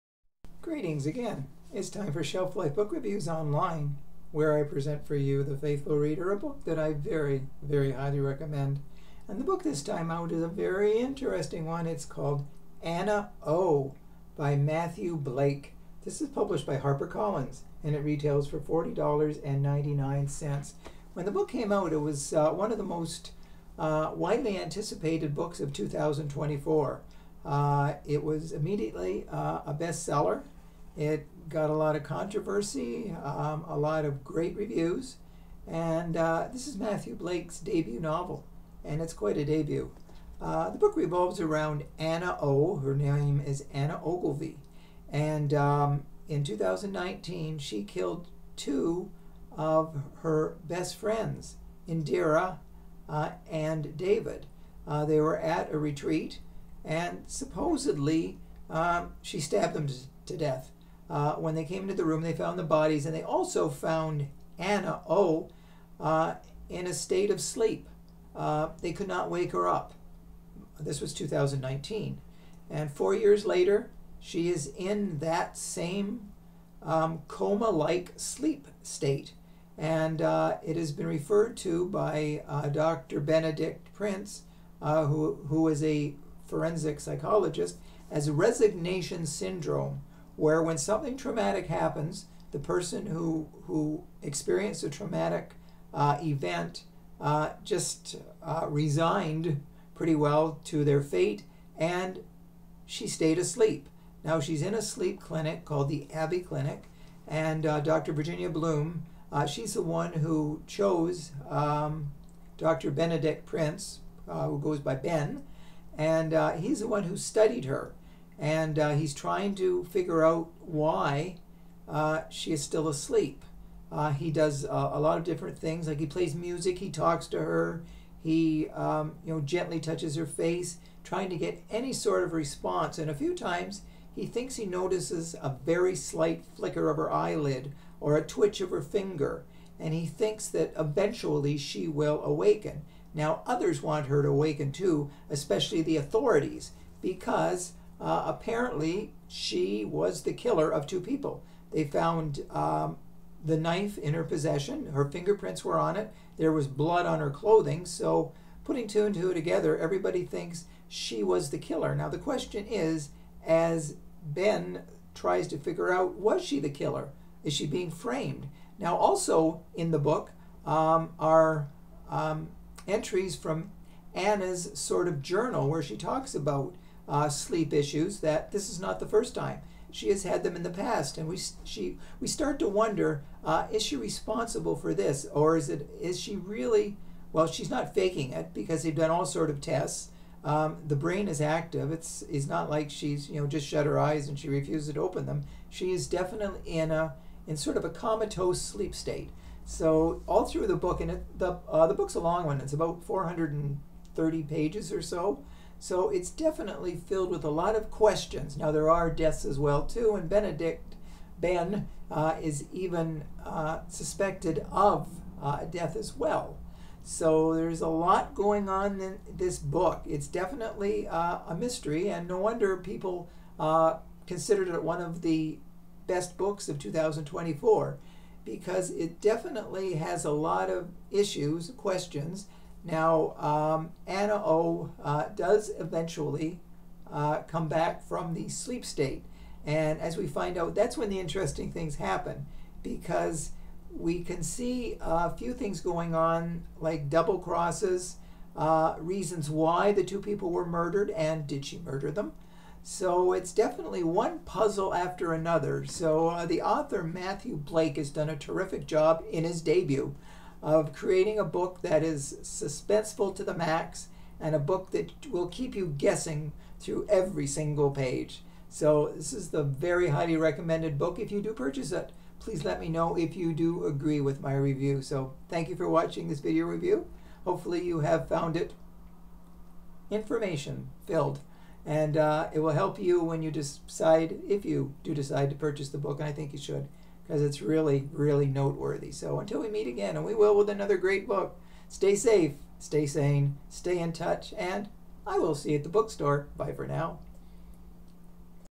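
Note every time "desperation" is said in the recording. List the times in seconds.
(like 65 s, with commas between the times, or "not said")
not said.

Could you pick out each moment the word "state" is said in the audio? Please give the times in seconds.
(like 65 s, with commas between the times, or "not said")
66 s, 78 s, 198 s, 238 s.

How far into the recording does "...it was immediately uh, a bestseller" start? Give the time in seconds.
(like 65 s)
28 s.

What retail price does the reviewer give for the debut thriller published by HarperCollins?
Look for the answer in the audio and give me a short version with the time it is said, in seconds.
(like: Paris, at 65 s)
$40.99, at 18 s.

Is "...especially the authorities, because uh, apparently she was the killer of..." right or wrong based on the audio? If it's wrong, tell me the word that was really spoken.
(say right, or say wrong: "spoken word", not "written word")
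right.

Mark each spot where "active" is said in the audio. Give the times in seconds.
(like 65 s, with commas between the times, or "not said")
191 s.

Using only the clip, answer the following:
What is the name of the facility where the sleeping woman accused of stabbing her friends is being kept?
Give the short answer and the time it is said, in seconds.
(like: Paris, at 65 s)
Abbey Clinic, at 106 s.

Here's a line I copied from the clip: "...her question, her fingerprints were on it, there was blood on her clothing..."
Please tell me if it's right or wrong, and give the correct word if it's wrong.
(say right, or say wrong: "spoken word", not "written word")
wrong: "possession", not "question".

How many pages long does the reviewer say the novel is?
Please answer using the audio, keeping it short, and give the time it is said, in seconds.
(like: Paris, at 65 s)
430, at 203 s.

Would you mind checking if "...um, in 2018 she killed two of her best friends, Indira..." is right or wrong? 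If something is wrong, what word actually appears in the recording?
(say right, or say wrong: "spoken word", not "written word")
wrong: "2019", not "2018".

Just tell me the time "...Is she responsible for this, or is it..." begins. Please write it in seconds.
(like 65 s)
183 s.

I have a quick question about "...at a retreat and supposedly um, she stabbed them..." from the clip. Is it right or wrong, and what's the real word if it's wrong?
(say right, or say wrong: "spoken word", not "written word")
right.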